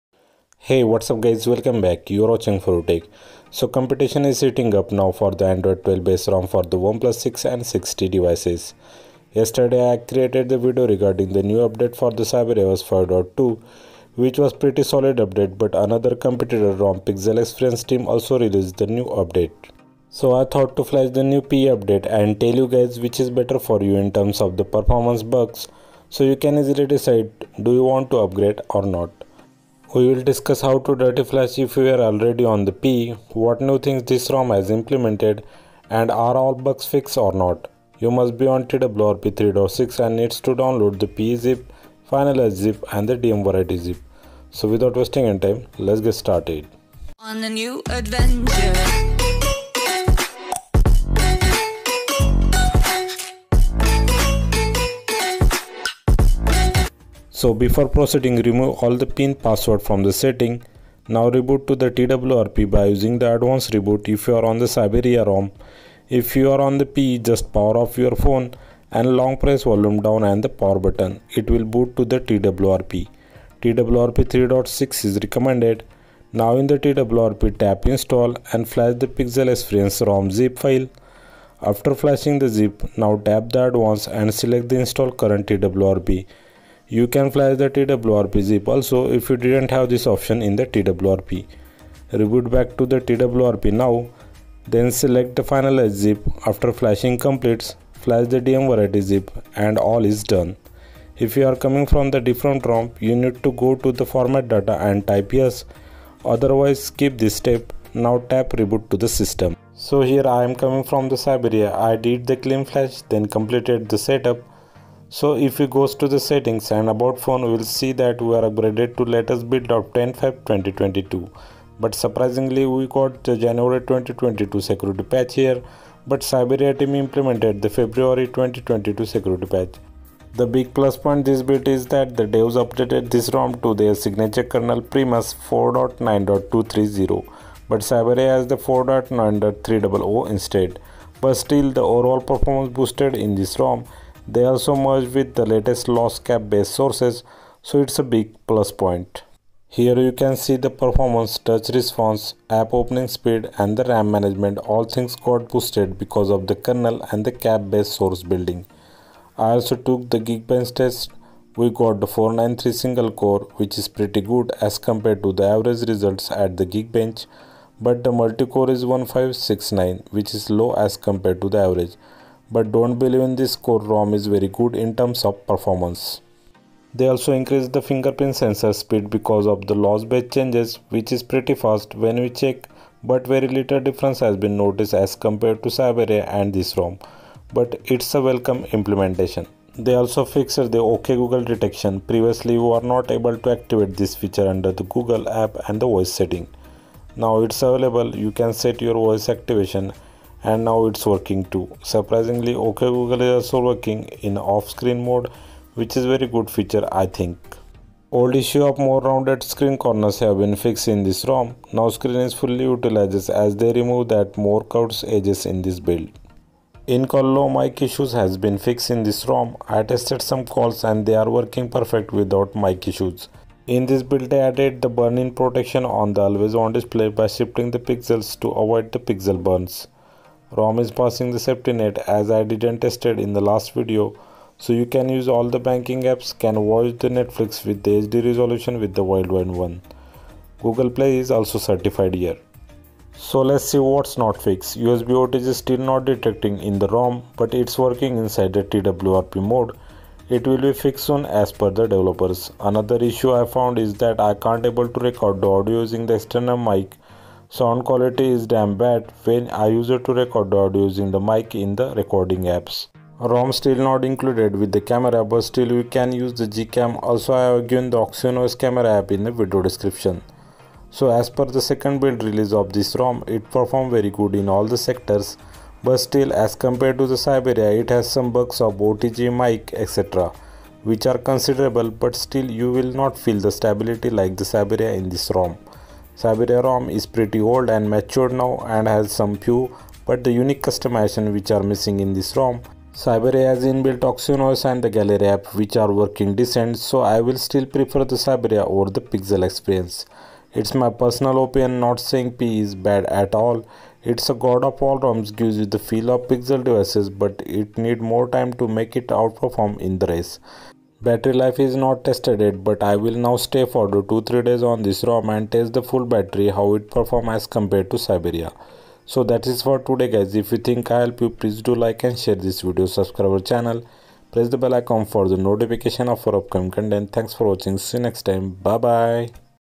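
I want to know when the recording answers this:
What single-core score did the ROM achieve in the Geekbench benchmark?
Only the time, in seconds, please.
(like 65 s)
162 s.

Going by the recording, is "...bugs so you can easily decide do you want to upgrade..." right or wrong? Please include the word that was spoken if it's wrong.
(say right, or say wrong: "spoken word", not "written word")
right.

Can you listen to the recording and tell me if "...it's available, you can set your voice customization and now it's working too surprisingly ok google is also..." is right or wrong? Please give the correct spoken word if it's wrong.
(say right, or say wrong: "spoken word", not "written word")
wrong: "activation", not "customization".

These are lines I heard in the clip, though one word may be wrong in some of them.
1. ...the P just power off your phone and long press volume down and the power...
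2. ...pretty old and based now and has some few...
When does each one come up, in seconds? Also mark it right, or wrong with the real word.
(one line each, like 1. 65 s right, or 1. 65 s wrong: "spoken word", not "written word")
1. 66 s right
2. 287 s wrong: "matured", not "based".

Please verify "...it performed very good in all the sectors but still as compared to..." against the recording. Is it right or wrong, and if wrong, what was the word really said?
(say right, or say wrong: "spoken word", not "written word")
right.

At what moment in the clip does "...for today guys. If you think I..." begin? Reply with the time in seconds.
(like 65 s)
319 s.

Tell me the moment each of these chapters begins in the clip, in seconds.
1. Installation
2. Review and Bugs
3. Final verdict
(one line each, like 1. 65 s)
1. 58 s
2. 115 s
3. 272 s.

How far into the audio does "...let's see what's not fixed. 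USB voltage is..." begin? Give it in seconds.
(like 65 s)
243 s.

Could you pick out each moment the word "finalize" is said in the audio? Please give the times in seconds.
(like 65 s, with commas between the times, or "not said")
42 s, 95 s.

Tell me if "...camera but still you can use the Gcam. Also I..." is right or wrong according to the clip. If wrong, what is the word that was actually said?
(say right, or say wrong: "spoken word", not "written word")
right.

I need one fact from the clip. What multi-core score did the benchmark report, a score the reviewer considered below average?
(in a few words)
1569.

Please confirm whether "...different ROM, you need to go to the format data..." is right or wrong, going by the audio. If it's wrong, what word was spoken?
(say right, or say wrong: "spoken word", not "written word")
right.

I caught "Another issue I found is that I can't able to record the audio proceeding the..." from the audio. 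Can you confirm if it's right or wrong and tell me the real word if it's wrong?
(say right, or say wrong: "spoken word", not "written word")
wrong: "using", not "proceeding".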